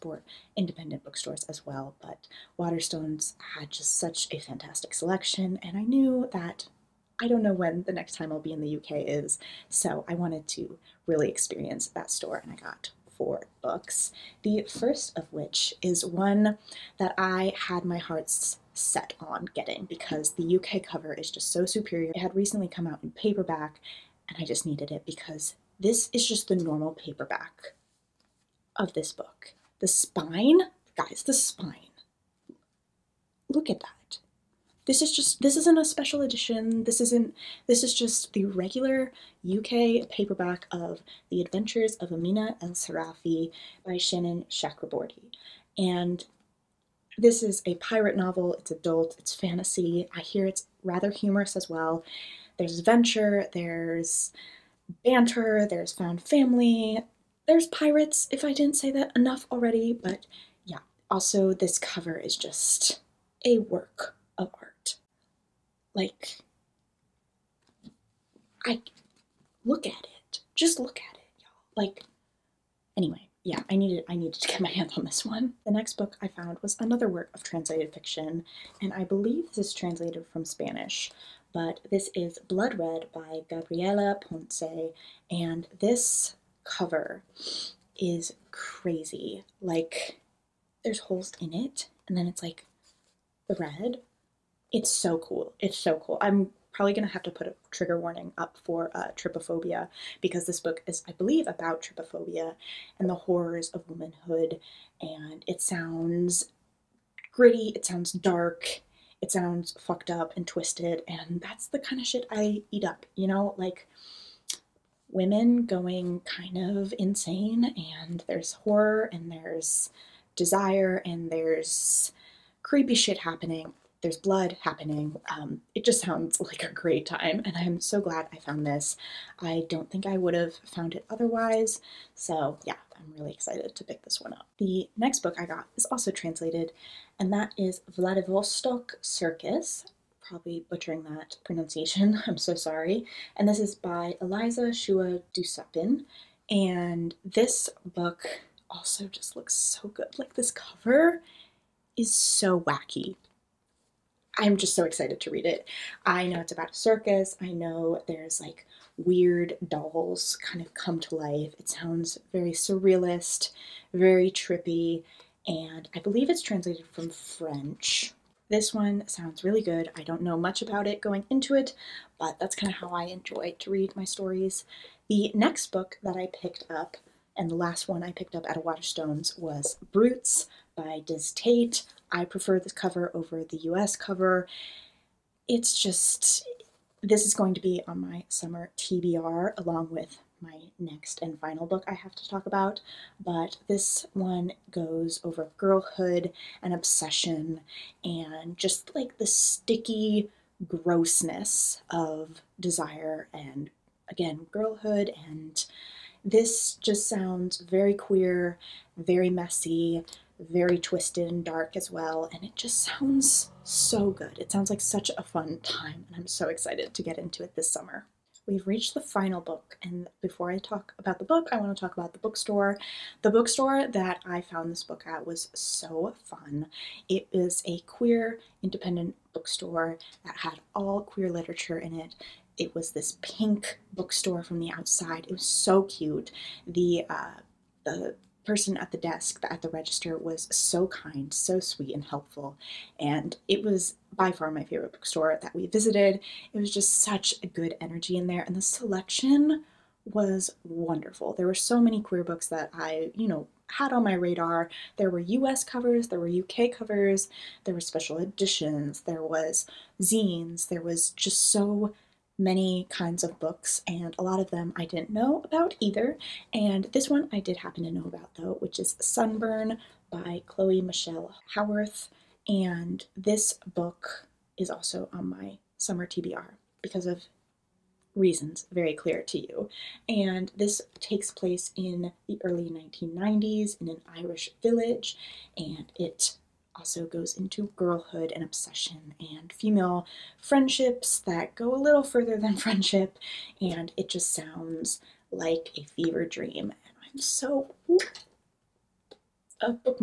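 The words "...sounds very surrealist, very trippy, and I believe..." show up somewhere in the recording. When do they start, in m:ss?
2:41.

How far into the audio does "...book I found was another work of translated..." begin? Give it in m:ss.
1:15.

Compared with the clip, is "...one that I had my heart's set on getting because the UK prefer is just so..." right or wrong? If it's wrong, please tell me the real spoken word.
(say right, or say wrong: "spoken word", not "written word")
wrong: "cover", not "prefer".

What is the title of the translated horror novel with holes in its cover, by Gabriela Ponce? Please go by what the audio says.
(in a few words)
Blood Red.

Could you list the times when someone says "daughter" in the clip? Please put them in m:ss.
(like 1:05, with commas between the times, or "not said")
not said.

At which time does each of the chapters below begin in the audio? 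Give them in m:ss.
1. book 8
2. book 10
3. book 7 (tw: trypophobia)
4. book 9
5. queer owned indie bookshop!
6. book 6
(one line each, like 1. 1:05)
1. 2:14
2. 4:26
3. 1:15
4. 2:55
5. 3:38
6. 0:15.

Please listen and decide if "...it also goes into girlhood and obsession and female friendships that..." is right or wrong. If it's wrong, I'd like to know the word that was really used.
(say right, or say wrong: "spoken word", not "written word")
right.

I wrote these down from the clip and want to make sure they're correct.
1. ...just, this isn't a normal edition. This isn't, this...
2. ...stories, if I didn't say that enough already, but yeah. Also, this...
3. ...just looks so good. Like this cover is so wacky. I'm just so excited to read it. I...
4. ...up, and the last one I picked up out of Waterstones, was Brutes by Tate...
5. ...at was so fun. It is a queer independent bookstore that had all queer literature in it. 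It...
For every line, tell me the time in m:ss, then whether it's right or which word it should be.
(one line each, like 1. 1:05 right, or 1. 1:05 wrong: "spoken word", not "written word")
1. 0:35 wrong: "special", not "normal"
2. 0:57 wrong: "pirates", not "stories"
3. 2:29 right
4. 2:56 wrong: "Dizz", not "Tate"
5. 3:45 right.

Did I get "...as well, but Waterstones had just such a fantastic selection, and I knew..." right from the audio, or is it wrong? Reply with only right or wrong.
right.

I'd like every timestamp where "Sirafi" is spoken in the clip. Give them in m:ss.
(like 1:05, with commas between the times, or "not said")
0:42.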